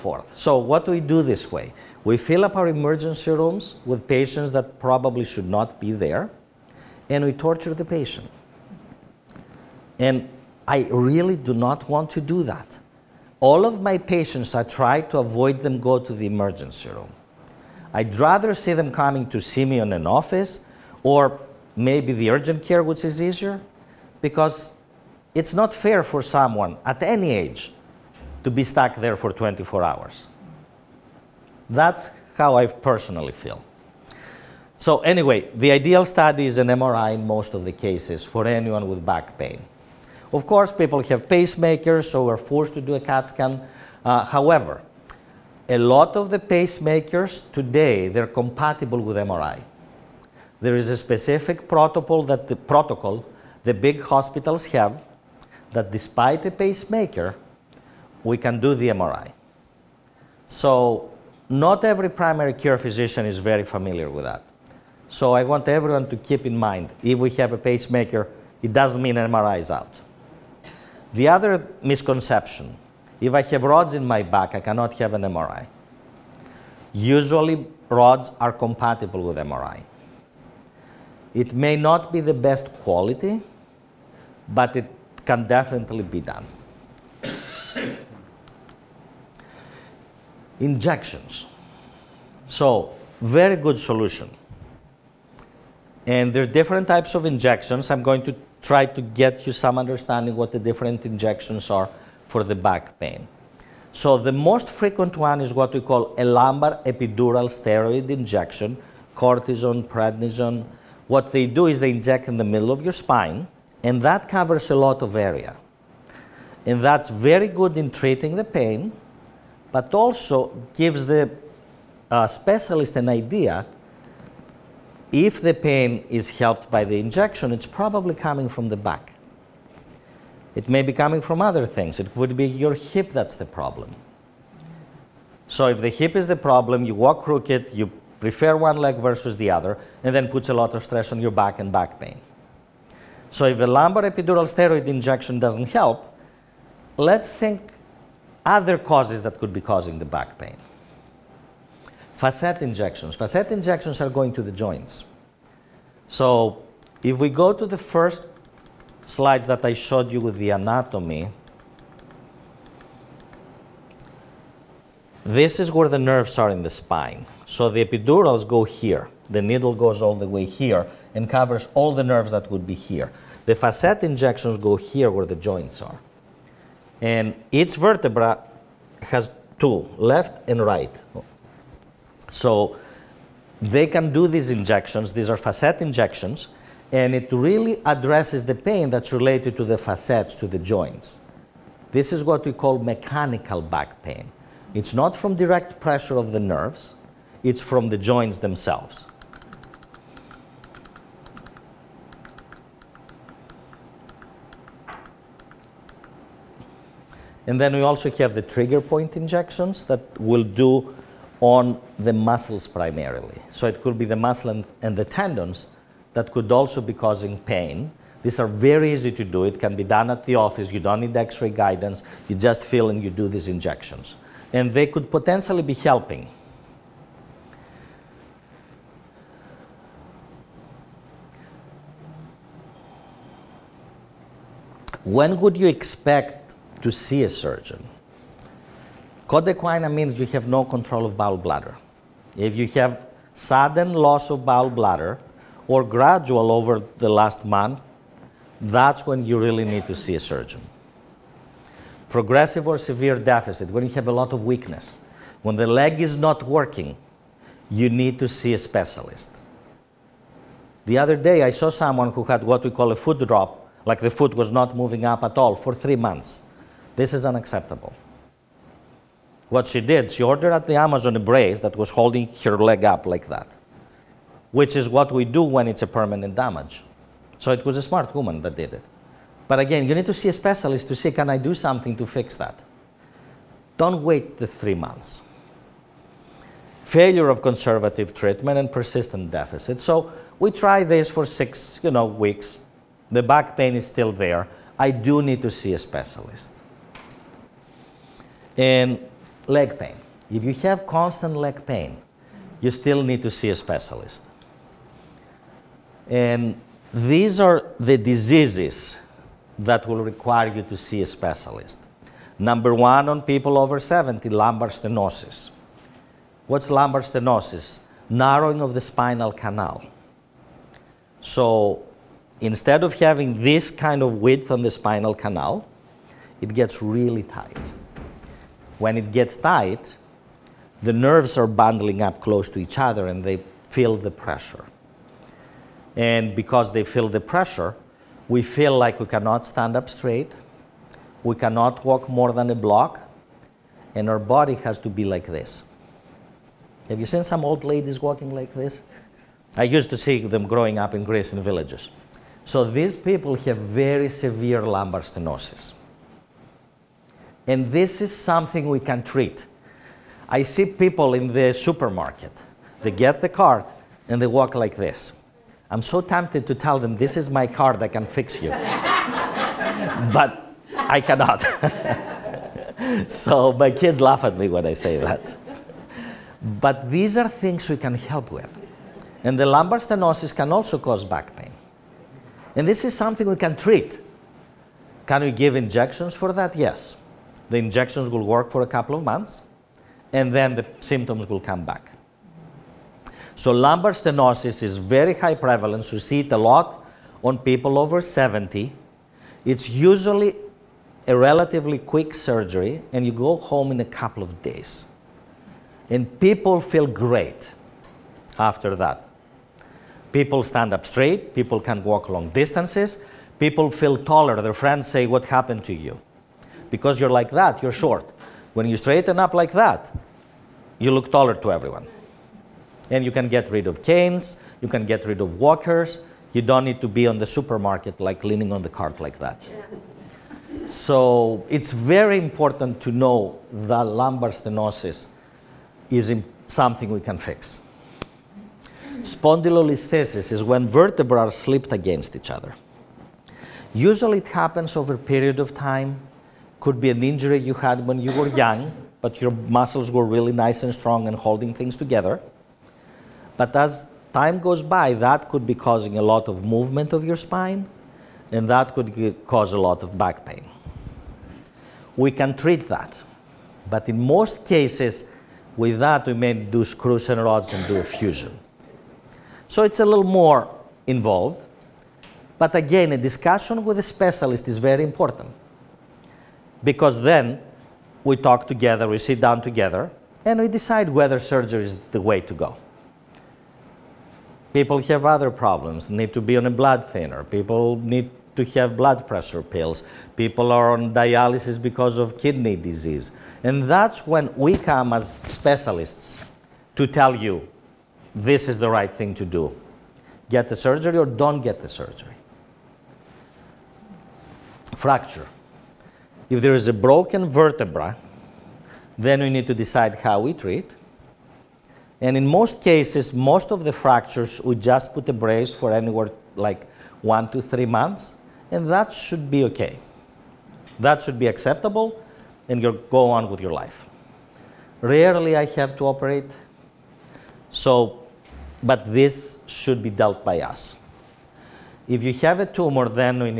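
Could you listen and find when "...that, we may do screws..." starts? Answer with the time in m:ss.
7:45.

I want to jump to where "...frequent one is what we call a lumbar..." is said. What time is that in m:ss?
1:44.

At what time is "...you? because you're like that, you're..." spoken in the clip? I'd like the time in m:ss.
6:55.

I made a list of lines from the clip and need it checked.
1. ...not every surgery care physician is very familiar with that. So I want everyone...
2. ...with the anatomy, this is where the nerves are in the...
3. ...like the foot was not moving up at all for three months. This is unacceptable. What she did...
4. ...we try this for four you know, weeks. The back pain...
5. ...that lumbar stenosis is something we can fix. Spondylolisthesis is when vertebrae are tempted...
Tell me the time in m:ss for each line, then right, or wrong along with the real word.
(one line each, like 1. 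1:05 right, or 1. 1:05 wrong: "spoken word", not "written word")
1. 1:01 wrong: "primary", not "surgery"
2. 2:40 right
3. 4:23 right
4. 4:50 wrong: "six", not "four"
5. 7:13 wrong: "slipped", not "tempted".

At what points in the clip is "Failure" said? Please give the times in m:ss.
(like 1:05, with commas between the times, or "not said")
4:46.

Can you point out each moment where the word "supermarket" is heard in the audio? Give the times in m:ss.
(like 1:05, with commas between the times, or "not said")
6:01, 7:07.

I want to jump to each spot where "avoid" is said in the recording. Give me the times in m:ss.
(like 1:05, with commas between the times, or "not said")
0:15.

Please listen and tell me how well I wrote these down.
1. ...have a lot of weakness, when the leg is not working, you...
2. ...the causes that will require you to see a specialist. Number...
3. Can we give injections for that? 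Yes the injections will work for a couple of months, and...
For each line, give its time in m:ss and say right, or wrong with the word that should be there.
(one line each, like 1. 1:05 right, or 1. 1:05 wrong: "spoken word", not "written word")
1. 4:13 right
2. 5:07 wrong: "diseases", not "causes"
3. 6:25 right.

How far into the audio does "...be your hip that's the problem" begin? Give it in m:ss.
2:12.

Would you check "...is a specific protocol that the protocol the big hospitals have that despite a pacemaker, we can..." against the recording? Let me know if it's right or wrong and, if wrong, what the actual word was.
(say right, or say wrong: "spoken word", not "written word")
right.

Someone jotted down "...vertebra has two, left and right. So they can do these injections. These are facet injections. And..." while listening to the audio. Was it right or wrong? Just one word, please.
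right.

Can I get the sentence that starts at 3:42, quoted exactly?
You just feel and you do these injections.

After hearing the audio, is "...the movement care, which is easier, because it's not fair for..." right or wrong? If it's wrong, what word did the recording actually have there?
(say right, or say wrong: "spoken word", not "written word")
wrong: "urgent", not "movement".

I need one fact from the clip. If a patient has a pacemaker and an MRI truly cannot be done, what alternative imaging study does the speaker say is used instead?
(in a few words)
CAT scan.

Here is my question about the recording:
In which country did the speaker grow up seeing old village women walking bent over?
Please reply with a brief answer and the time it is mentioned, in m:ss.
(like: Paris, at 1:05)
Greece, at 5:51.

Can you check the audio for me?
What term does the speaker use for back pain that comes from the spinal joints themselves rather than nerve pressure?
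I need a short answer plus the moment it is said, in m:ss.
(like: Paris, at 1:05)
mechanical back pain, at 3:12.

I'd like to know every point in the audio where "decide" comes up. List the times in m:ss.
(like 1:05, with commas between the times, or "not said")
8:00, 8:29.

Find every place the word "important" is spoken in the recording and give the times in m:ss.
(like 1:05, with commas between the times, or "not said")
7:12, 7:54.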